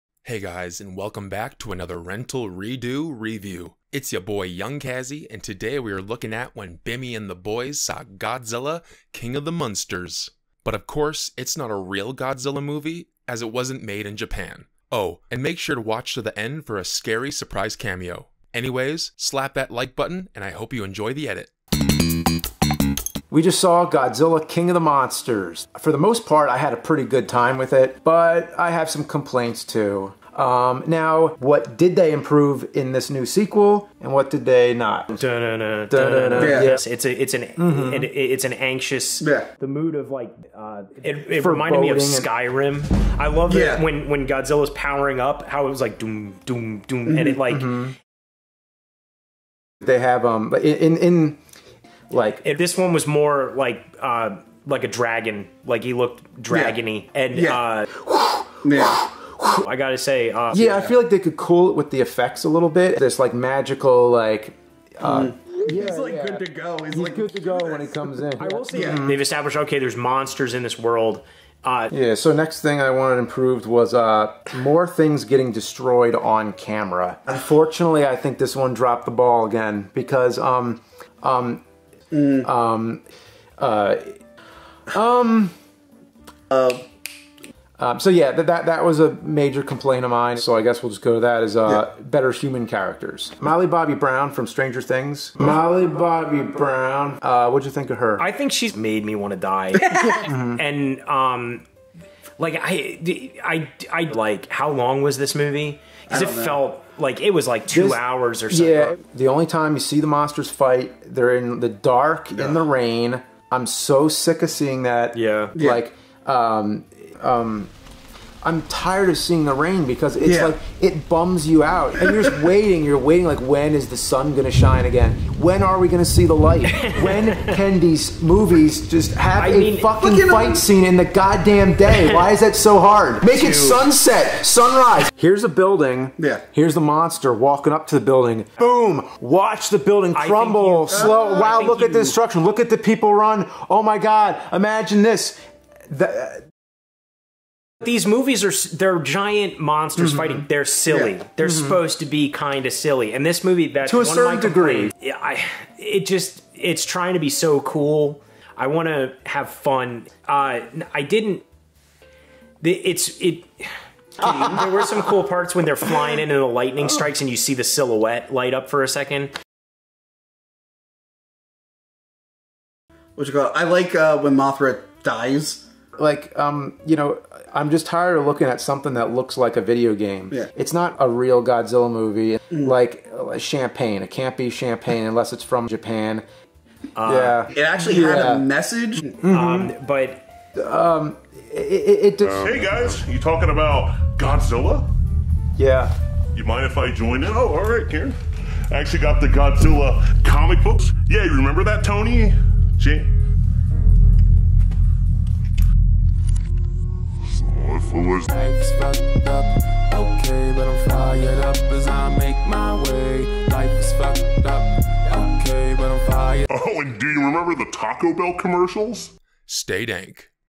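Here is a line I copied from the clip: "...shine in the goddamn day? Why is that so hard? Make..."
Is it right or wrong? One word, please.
wrong.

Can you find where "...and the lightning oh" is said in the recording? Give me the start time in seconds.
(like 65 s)
166 s.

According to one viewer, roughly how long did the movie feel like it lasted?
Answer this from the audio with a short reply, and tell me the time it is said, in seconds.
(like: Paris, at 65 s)
2 hours, at 107 s.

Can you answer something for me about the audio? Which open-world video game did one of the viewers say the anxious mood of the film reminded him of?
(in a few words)
Skyrim.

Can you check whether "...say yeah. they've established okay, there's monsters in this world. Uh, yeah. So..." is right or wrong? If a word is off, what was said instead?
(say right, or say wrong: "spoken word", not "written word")
right.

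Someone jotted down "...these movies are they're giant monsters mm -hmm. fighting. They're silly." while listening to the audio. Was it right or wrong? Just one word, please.
right.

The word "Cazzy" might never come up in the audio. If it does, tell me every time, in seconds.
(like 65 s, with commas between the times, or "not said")
4 s.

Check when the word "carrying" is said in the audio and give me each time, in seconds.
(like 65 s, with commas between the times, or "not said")
not said.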